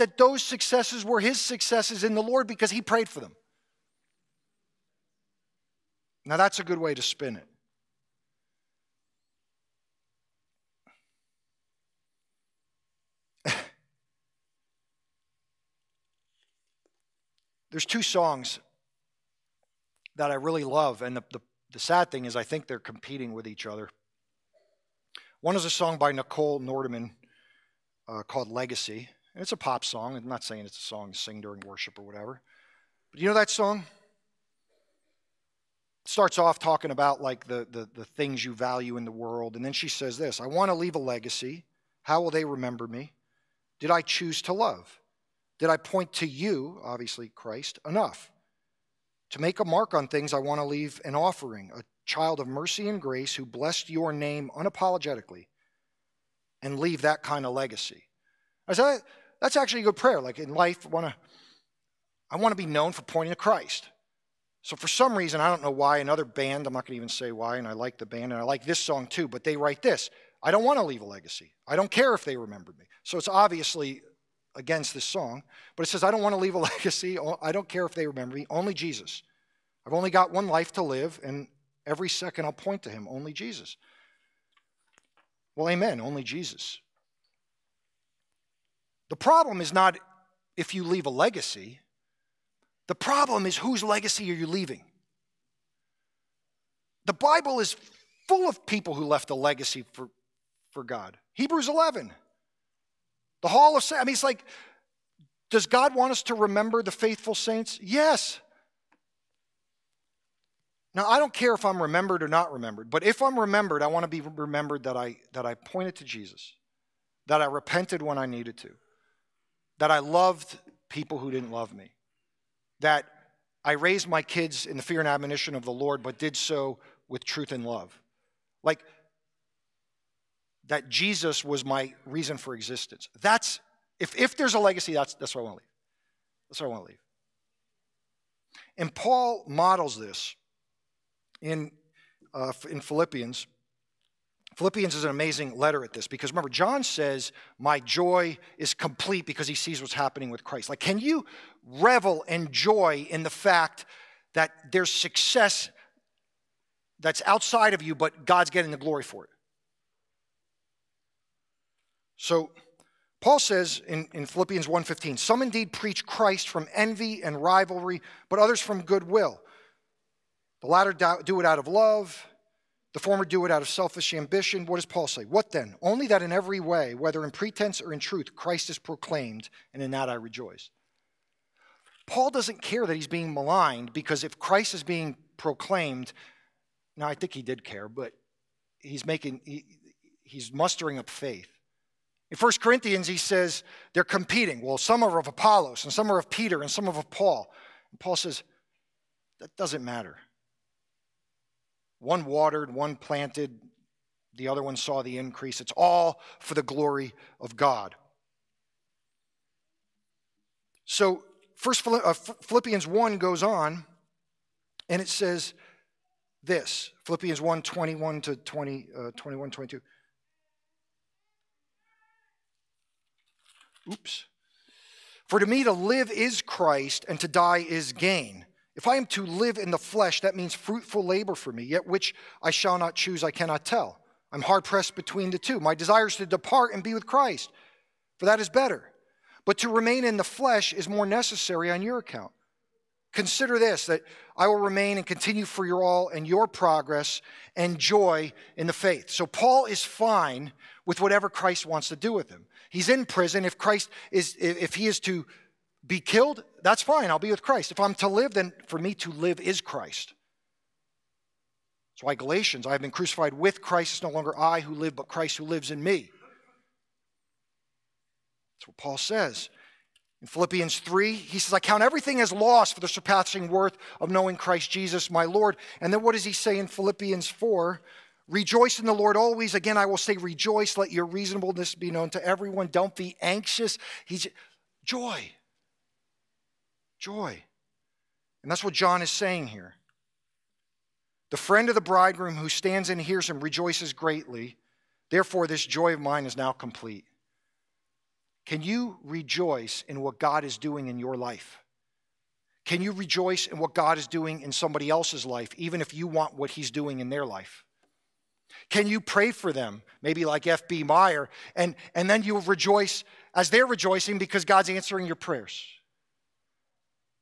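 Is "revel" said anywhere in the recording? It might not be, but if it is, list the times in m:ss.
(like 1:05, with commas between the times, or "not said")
2:31.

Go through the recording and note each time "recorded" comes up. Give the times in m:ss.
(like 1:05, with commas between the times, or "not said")
not said.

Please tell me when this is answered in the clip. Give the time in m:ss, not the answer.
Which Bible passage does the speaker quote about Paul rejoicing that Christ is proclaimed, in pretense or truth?
2:44.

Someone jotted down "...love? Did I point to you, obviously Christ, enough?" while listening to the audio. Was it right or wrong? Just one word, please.
right.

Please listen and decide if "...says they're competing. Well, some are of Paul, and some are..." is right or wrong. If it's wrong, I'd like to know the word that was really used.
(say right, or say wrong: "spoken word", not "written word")
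wrong: "Apollos", not "Paul".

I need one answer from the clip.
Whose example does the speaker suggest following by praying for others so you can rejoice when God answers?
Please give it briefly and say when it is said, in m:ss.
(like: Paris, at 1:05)
F.B. Meyer, at 5:10.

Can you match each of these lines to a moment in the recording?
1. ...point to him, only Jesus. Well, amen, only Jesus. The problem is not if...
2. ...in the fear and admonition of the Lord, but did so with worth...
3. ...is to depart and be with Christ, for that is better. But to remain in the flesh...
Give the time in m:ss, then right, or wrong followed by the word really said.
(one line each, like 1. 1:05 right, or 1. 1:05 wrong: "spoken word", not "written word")
1. 1:22 right
2. 2:04 wrong: "truth", not "worth"
3. 3:56 right.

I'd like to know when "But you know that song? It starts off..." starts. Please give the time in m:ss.
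0:33.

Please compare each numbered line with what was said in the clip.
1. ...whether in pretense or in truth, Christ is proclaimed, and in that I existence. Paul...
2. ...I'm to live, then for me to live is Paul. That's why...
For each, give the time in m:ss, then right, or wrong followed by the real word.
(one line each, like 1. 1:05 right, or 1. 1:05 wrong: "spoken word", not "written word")
1. 2:56 wrong: "rejoice", not "existence"
2. 4:17 wrong: "Christ", not "Paul".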